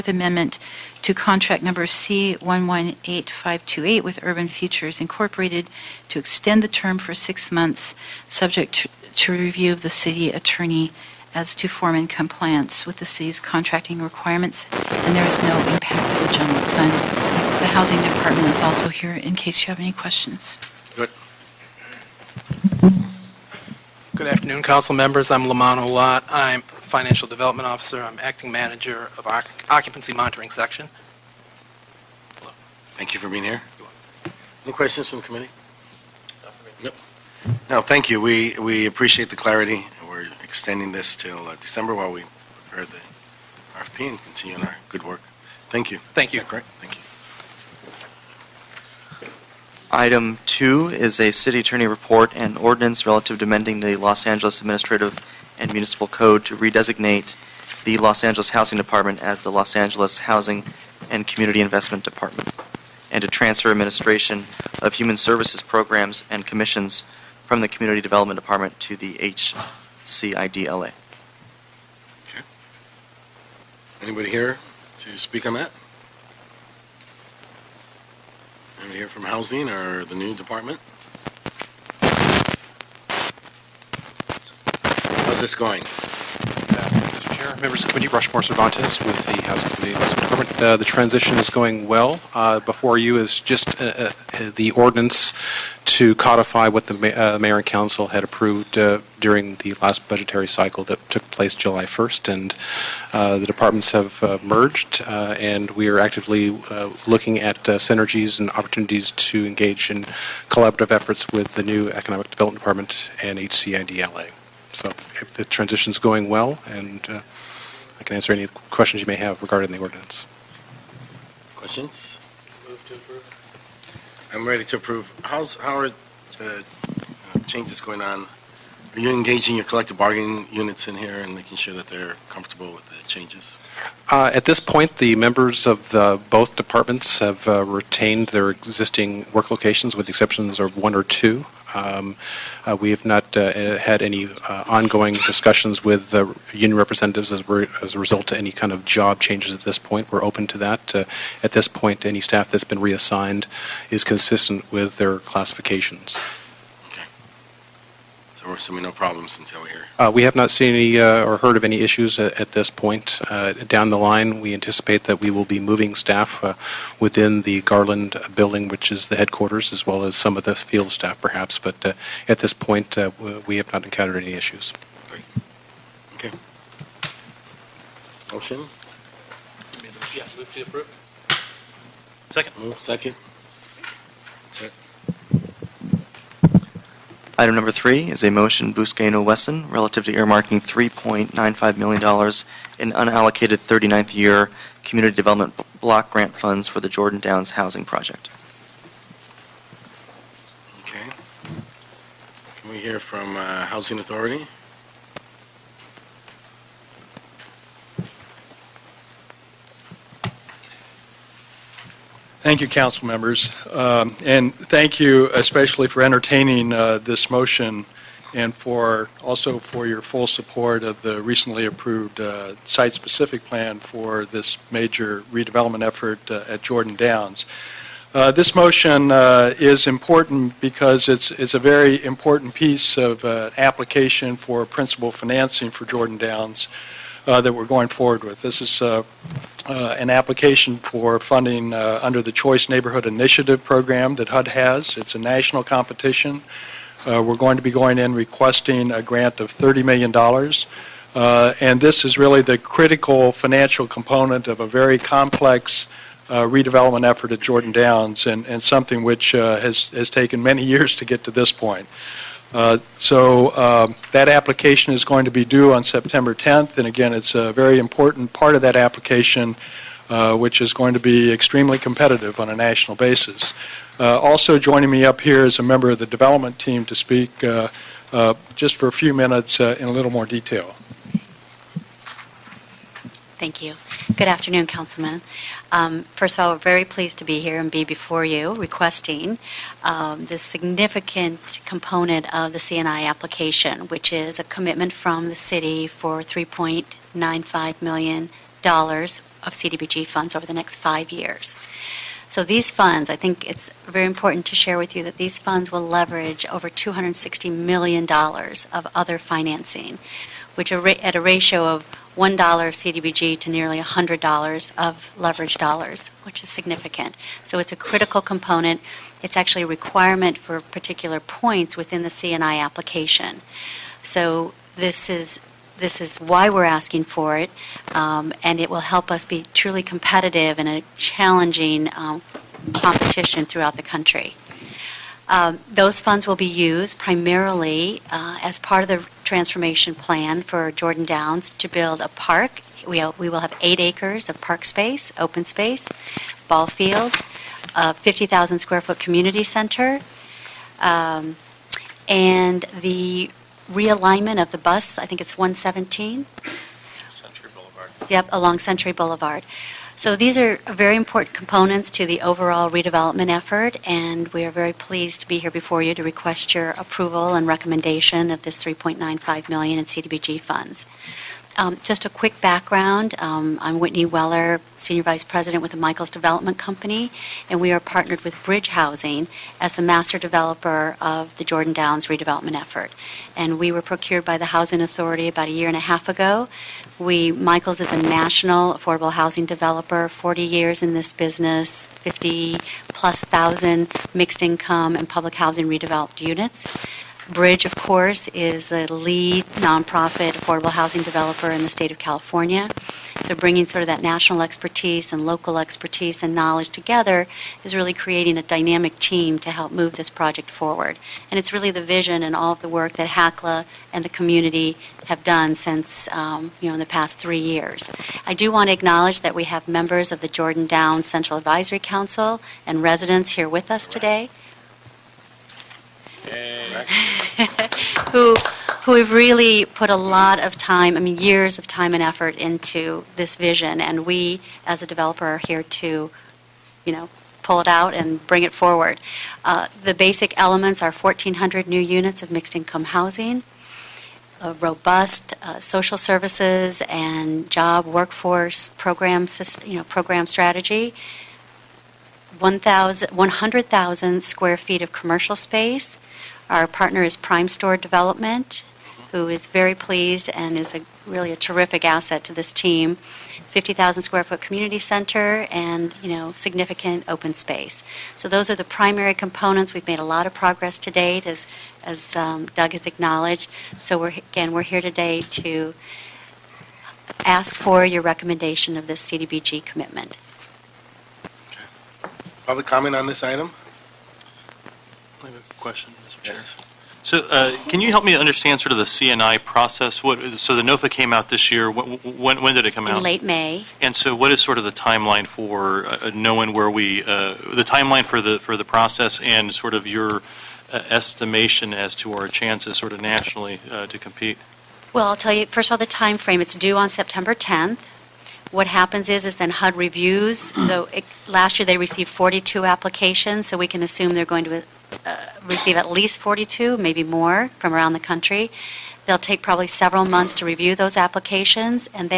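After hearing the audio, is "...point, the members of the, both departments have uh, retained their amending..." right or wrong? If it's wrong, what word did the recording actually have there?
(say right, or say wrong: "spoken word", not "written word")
wrong: "existing", not "amending".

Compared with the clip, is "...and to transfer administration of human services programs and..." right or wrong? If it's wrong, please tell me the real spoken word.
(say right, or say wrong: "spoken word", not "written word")
right.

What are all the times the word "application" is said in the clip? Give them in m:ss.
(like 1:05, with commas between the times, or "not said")
3:53, 4:00, 4:24, 4:28, 4:53, 5:22, 8:32, 8:40.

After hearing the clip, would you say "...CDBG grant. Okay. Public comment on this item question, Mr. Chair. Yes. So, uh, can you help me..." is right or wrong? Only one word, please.
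wrong.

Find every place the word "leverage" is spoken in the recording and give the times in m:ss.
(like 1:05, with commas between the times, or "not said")
5:05, 5:15.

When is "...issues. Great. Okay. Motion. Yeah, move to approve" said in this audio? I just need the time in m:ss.
2:54.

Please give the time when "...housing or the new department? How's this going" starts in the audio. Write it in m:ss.
1:19.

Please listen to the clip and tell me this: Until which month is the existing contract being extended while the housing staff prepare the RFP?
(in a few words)
December.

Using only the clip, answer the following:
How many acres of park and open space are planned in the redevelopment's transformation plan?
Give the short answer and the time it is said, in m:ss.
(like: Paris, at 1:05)
8, at 5:43.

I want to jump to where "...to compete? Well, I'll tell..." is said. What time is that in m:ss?
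8:23.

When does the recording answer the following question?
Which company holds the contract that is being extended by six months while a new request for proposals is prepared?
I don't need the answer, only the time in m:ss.
0:04.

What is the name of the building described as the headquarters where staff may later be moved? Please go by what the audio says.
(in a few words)
Garland building.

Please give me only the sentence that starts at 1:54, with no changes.
So if the transition's going well, and uh, I can answer any questions you may have regarding the ordinance.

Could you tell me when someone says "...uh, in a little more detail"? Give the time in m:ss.
4:39.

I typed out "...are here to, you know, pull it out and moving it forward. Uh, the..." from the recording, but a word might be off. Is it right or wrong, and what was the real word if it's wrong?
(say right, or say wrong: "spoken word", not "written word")
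wrong: "bring", not "moving".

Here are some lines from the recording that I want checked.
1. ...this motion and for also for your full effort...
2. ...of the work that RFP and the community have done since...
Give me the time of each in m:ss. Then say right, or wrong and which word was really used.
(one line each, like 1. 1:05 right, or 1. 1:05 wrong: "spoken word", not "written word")
1. 3:36 wrong: "support", not "effort"
2. 6:52 wrong: "HACLA", not "RFP".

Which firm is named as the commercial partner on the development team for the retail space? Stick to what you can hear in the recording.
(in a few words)
Primestor Development.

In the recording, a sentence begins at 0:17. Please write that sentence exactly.
The housing department is also here in case you have any questions.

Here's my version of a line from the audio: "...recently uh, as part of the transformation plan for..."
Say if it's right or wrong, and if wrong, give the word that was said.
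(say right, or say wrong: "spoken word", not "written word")
wrong: "primarily", not "recently".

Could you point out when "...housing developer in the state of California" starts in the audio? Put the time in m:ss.
6:40.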